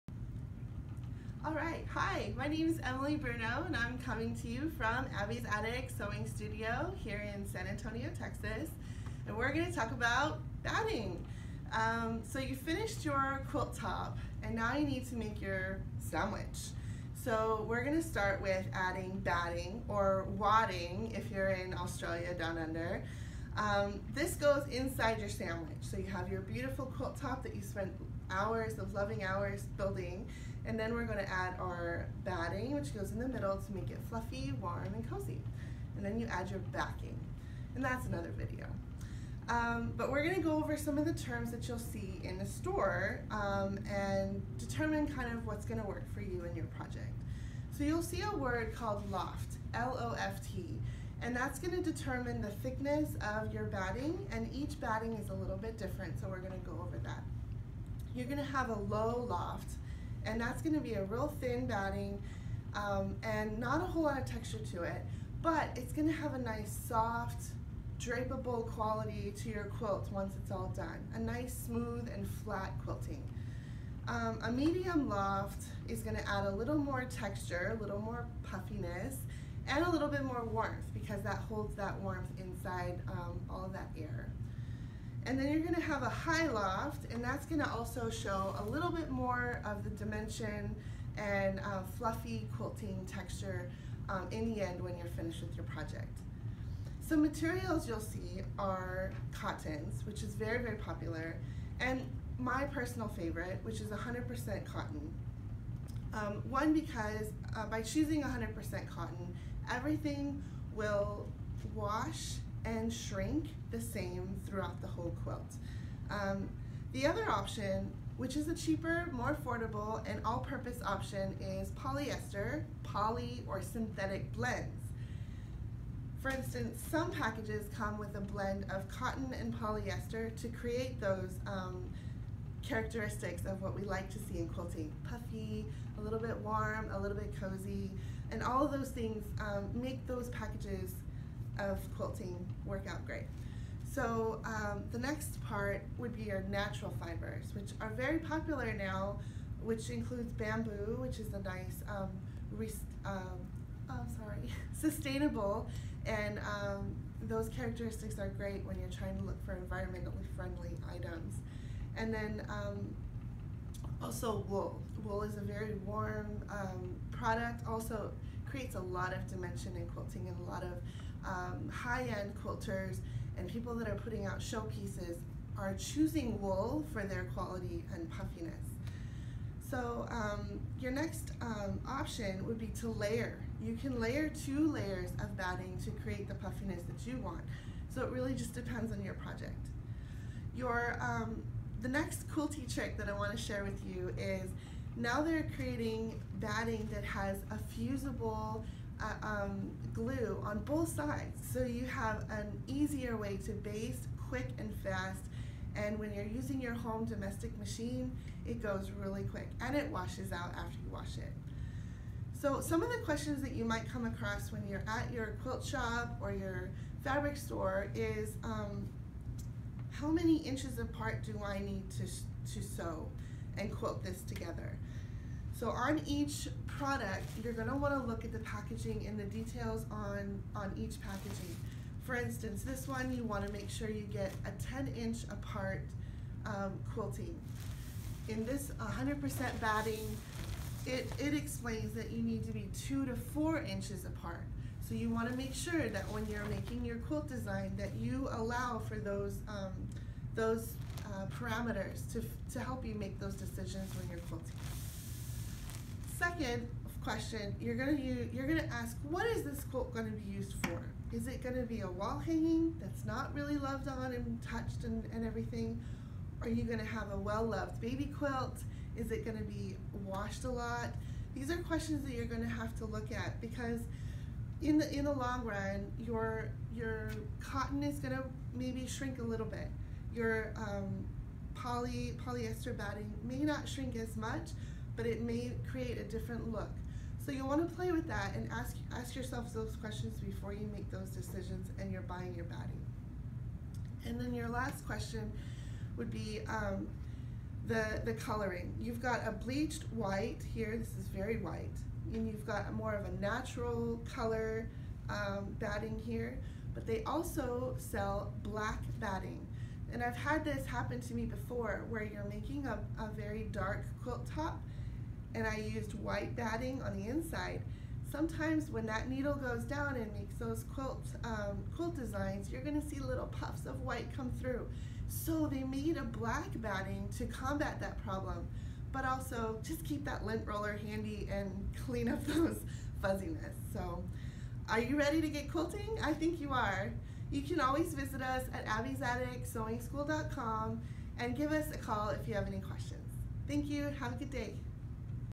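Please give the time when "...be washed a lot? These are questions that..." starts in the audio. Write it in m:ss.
4:29.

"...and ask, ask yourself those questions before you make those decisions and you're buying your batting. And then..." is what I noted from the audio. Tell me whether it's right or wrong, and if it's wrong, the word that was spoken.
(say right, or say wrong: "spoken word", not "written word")
right.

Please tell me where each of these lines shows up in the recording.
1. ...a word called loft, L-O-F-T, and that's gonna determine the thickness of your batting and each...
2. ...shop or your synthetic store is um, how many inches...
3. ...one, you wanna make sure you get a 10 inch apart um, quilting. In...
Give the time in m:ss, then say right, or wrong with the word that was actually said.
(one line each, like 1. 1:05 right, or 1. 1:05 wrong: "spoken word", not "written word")
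1. 0:48 right
2. 3:35 wrong: "fabric", not "synthetic"
3. 3:52 right.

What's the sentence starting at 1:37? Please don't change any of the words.
So materials you'll see are cottons, which is very, very popular, and my personal favorite, which is 100% cotton.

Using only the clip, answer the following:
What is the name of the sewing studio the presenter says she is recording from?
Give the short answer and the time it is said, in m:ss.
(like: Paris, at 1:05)
Abby's Attic Sewing Studio, at 0:05.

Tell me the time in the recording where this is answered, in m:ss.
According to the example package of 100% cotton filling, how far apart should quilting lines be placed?
4:02.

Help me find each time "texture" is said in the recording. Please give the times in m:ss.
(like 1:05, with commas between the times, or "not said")
1:04, 1:17, 1:33.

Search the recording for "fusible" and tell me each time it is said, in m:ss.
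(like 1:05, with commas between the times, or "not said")
3:17.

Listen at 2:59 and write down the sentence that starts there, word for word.
So um, your next um, option would be to layer.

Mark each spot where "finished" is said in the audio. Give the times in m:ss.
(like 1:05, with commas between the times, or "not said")
0:12, 1:35.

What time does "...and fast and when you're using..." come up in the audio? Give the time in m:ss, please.
3:24.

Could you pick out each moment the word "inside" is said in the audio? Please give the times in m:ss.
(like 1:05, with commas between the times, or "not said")
0:24, 1:22, 5:17.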